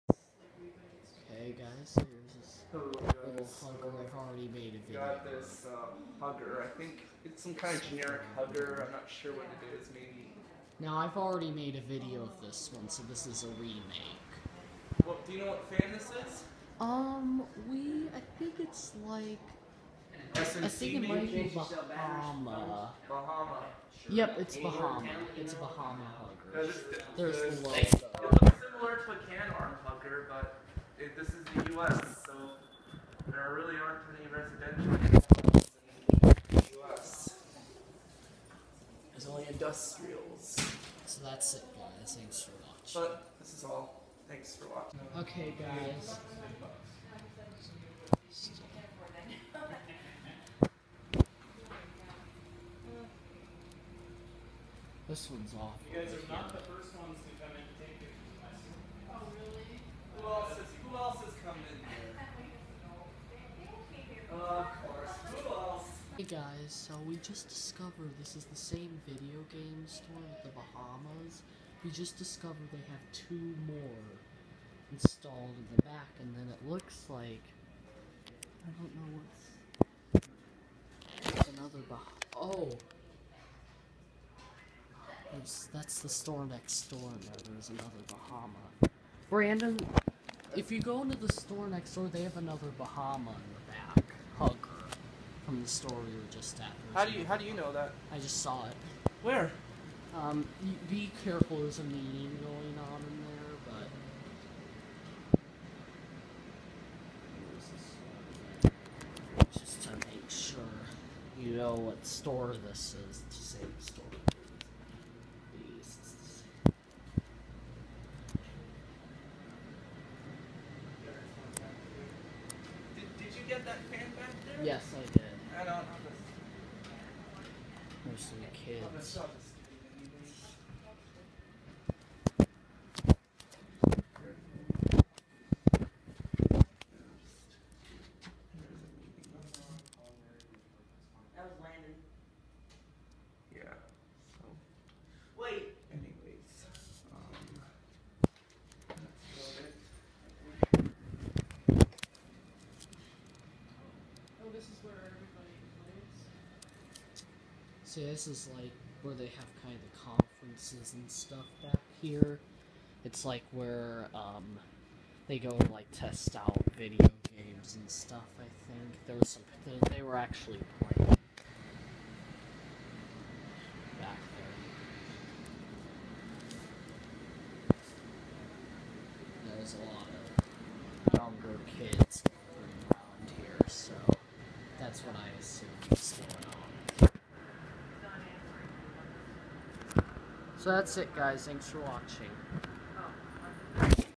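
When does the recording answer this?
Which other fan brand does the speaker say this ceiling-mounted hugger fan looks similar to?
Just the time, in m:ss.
0:29.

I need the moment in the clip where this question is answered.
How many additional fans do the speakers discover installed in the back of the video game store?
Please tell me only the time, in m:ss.
1:13.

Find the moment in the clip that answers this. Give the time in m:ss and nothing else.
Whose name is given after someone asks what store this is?
2:21.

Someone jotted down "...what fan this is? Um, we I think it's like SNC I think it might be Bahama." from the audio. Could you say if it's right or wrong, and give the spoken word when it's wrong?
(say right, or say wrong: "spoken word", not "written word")
right.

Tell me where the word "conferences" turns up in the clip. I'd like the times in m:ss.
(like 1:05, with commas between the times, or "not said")
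2:40.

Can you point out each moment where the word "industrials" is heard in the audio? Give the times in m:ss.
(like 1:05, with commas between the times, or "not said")
0:39.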